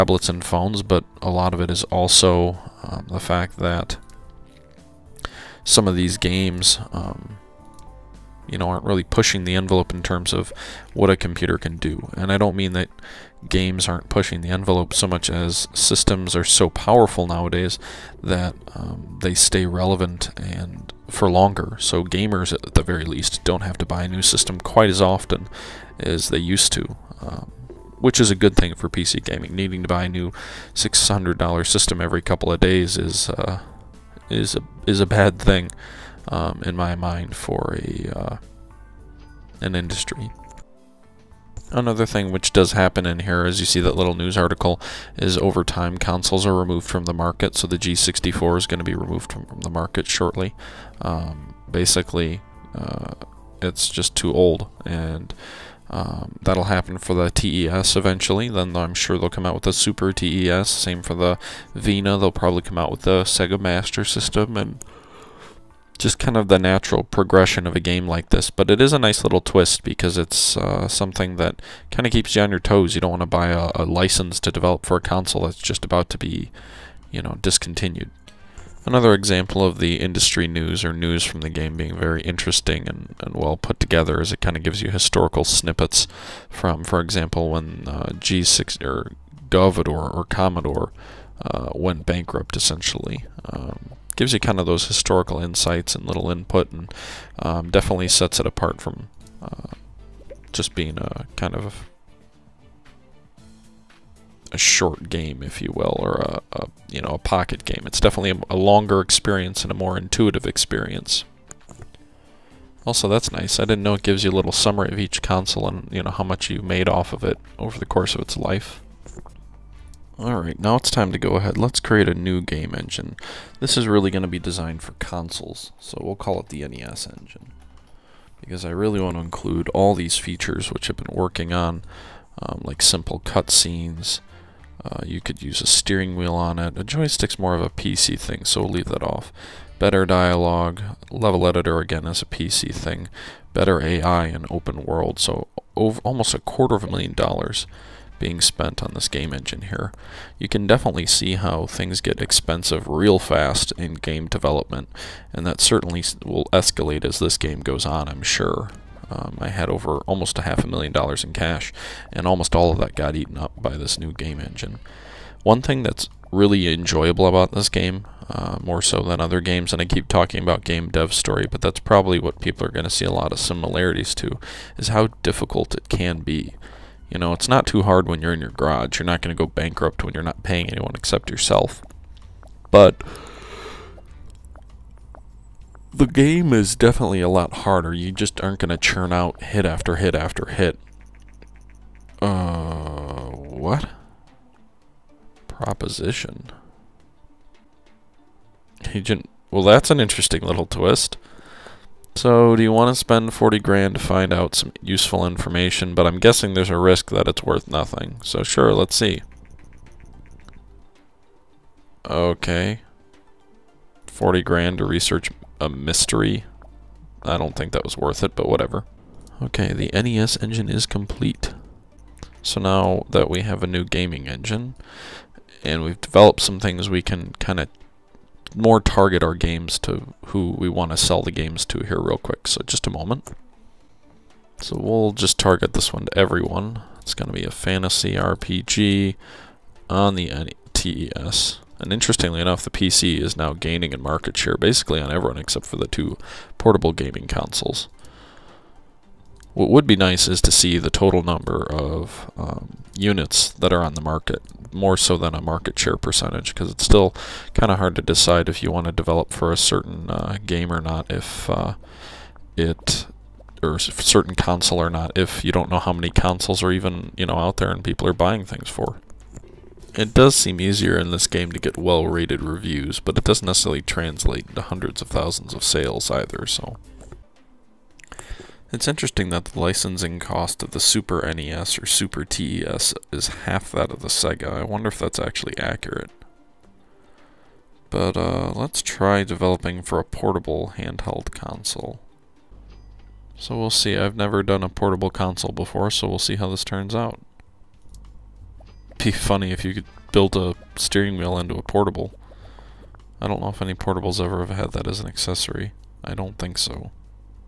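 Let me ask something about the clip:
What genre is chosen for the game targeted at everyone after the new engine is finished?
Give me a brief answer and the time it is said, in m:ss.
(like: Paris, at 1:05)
fantasy RPG, at 3:57.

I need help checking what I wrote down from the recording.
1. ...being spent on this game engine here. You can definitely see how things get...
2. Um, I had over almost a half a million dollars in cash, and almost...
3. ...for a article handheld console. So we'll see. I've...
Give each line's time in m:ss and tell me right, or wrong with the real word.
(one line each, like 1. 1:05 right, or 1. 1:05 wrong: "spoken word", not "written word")
1. 2:28 right
2. 2:39 right
3. 4:49 wrong: "portable", not "article".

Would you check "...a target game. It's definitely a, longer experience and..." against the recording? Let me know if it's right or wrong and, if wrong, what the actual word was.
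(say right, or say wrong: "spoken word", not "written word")
wrong: "pocket", not "target".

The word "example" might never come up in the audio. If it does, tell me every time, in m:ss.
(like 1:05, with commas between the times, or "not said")
1:19, 1:26.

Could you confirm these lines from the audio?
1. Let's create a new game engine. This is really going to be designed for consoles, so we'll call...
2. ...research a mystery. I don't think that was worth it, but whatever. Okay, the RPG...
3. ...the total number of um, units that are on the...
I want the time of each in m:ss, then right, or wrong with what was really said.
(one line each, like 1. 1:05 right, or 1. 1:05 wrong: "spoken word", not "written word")
1. 2:01 right
2. 3:34 wrong: "NES", not "RPG"
3. 4:10 right.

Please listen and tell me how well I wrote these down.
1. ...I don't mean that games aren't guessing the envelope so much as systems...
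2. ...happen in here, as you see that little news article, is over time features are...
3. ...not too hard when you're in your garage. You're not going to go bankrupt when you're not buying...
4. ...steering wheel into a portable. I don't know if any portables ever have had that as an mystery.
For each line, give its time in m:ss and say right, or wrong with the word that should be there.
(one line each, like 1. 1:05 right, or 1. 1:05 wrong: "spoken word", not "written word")
1. 0:12 wrong: "pushing", not "guessing"
2. 0:42 wrong: "consoles", not "features"
3. 2:57 wrong: "paying", not "buying"
4. 5:00 wrong: "accessory", not "mystery".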